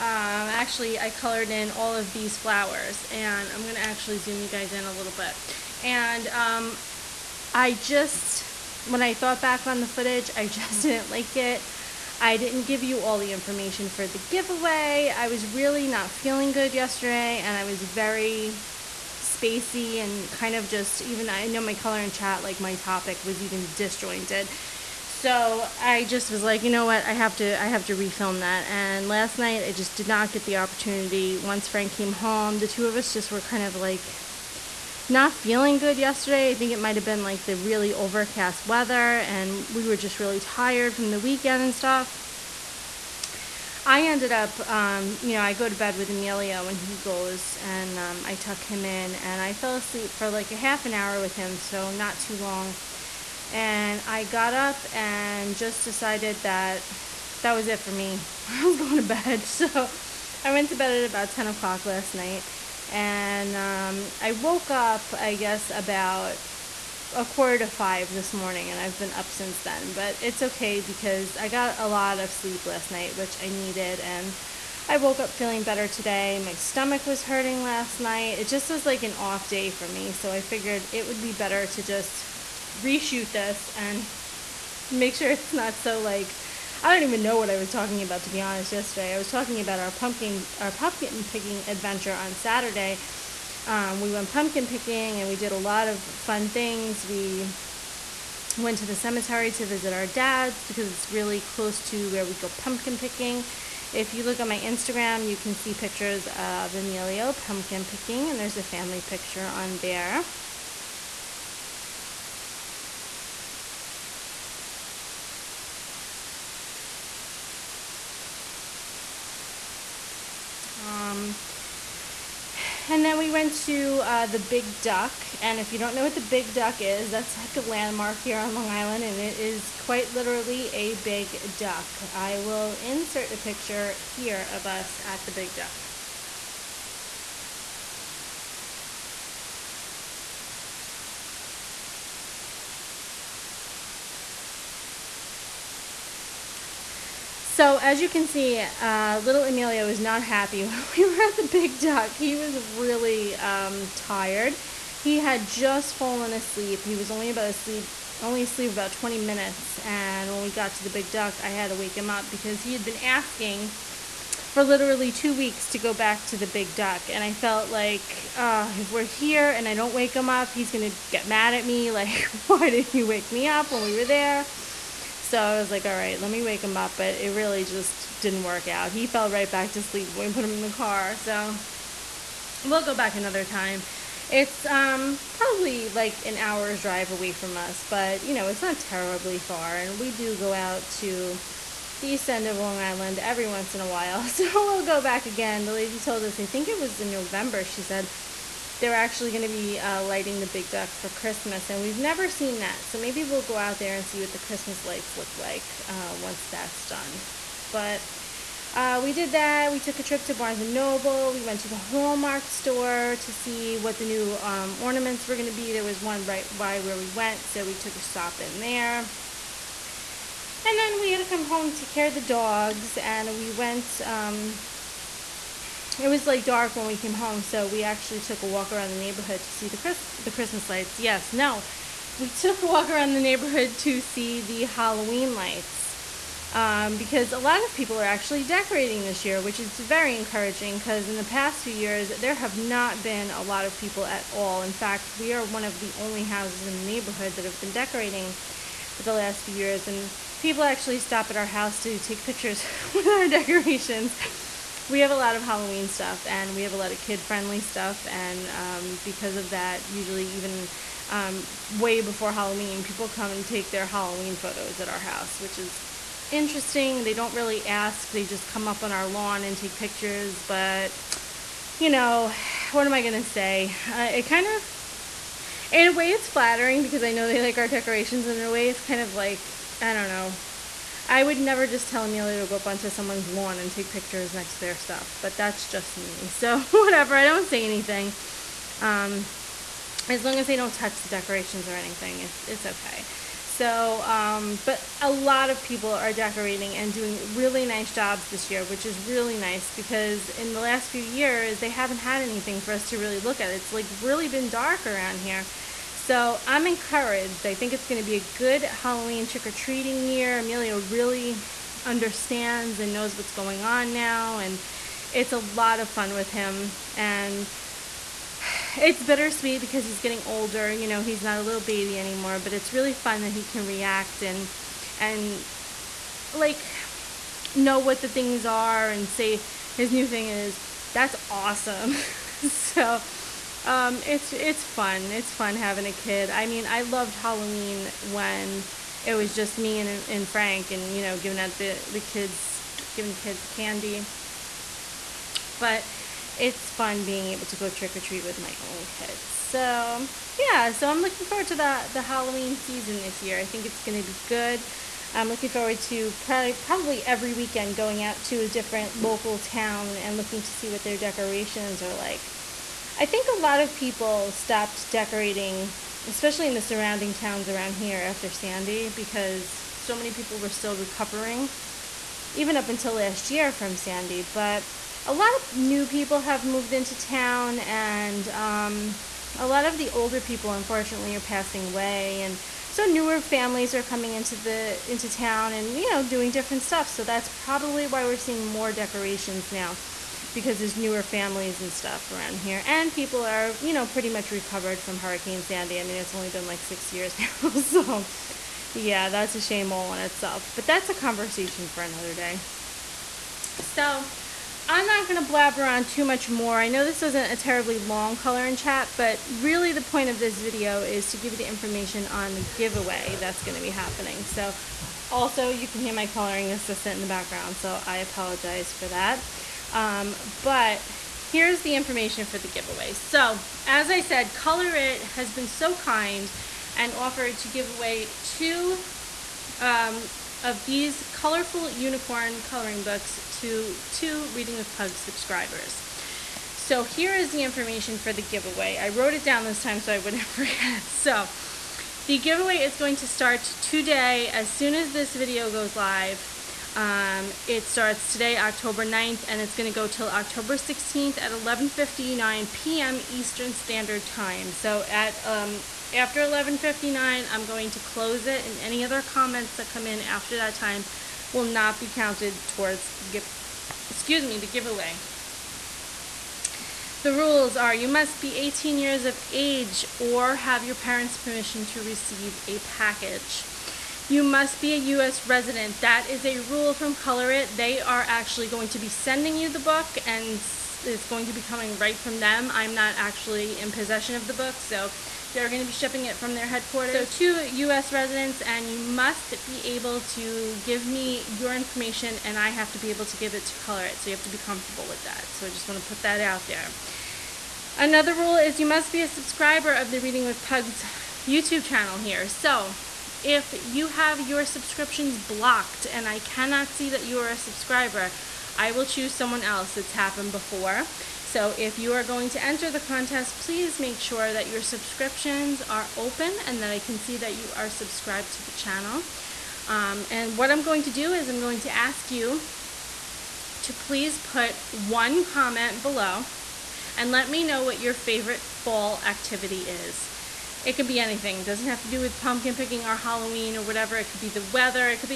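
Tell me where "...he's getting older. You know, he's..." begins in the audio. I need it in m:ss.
5:19.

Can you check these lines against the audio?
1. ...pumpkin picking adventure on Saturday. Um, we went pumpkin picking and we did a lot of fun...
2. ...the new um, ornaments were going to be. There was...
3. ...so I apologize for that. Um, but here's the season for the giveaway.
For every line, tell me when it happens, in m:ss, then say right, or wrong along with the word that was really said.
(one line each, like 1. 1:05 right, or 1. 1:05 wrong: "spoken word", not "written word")
1. 1:30 right
2. 3:33 right
3. 6:57 wrong: "information", not "season".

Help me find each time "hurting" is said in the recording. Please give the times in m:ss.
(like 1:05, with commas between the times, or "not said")
1:17.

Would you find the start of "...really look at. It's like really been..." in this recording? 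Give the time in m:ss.
5:02.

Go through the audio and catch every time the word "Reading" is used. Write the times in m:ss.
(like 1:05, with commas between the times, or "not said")
7:14, 8:20.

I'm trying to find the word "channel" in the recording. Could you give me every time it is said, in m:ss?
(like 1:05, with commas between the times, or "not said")
8:21, 8:38.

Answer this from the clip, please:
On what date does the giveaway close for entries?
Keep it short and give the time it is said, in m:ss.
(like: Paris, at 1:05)
October 16th, at 7:30.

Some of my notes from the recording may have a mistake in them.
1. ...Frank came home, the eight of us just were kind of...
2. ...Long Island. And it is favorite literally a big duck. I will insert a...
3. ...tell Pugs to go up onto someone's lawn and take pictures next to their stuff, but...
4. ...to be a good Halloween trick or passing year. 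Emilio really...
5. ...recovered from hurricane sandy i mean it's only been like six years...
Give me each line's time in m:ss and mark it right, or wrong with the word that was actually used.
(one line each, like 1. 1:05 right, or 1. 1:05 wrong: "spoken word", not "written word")
1. 0:31 wrong: "two", not "eight"
2. 2:08 wrong: "quite", not "favorite"
3. 4:41 wrong: "Emilio", not "Pugs"
4. 5:08 wrong: "treating", not "passing"
5. 6:34 right.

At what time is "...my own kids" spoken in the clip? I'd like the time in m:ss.
5:48.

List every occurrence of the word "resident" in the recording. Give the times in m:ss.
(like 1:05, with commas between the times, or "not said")
7:55, 8:07.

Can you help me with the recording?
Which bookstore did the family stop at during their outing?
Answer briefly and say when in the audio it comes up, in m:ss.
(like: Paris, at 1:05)
Barnes and Noble, at 3:30.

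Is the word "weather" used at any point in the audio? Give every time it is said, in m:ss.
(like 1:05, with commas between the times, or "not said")
0:38, 8:54.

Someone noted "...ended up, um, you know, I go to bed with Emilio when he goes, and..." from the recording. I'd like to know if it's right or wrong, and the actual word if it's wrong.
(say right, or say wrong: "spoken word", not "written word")
right.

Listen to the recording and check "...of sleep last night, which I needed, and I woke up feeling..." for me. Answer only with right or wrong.
right.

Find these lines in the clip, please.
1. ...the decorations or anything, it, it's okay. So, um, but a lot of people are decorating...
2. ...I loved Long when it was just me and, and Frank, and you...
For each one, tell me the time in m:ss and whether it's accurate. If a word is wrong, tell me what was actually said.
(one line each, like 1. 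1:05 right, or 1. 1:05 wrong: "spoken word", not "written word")
1. 4:51 right
2. 5:36 wrong: "Halloween", not "Long".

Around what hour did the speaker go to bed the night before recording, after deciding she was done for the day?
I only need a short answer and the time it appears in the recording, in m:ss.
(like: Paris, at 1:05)
10 o'clock, at 1:01.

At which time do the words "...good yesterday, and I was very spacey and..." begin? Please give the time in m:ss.
0:16.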